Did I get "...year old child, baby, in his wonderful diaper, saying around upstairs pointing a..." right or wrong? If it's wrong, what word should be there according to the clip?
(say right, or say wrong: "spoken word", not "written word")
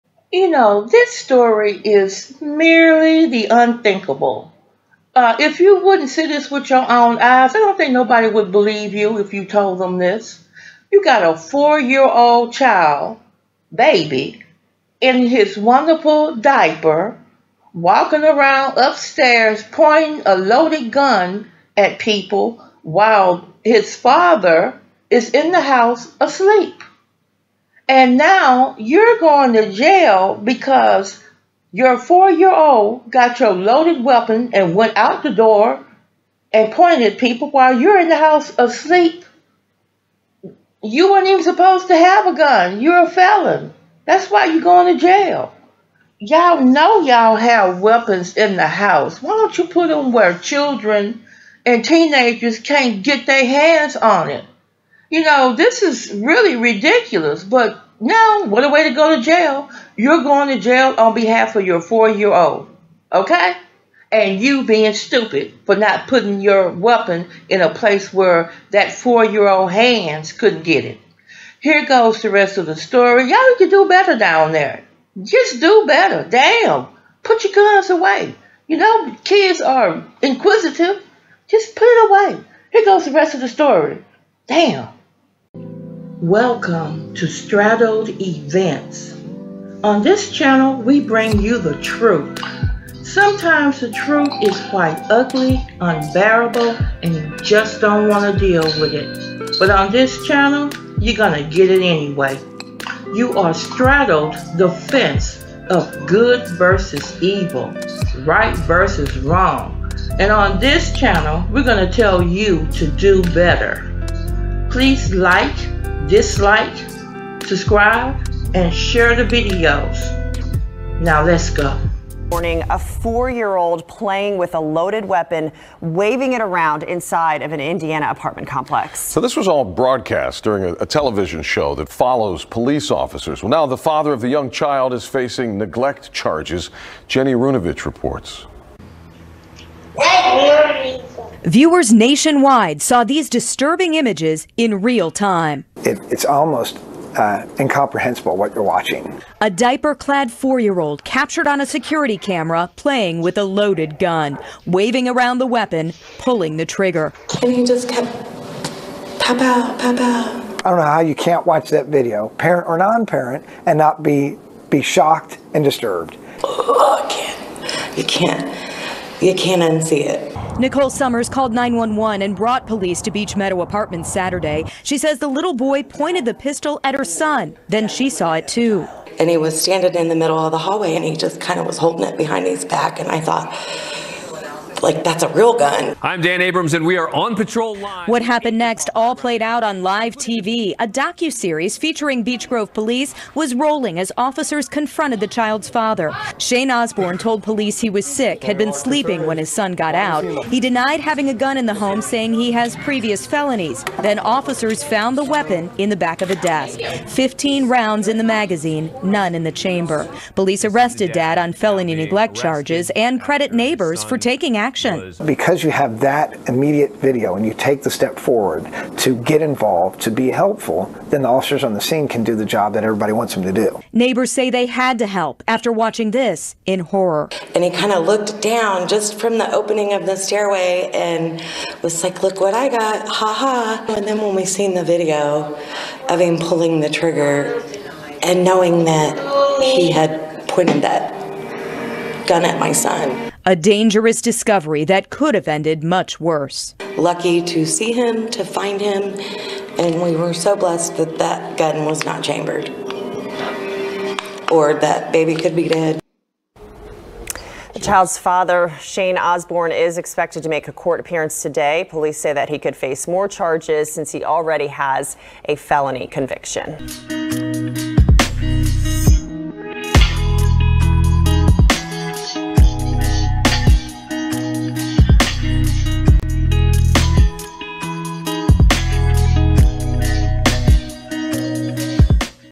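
wrong: "walking", not "saying".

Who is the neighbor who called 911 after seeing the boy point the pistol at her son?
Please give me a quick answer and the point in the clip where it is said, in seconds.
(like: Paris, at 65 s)
Nicole Summers, at 170 s.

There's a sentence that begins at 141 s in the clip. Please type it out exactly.
Viewers nationwide saw these disturbing images in real time.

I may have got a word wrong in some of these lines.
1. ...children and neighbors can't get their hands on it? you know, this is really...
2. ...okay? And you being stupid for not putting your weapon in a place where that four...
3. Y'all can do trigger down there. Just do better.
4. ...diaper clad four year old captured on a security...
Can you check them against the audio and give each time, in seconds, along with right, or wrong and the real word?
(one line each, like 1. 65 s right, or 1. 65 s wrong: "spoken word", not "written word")
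1. 50 s wrong: "teenagers", not "neighbors"
2. 63 s right
3. 73 s wrong: "better", not "trigger"
4. 149 s right.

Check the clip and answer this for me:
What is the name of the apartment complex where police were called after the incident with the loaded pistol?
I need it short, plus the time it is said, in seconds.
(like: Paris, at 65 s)
Beach Meadow Apartments, at 173 s.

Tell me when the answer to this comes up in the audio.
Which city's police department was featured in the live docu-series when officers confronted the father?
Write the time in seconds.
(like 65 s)
192 s.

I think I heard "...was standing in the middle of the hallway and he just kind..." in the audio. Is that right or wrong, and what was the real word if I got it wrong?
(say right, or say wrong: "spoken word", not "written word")
right.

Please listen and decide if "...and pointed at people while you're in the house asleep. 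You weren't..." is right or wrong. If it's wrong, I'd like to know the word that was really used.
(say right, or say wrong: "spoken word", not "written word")
right.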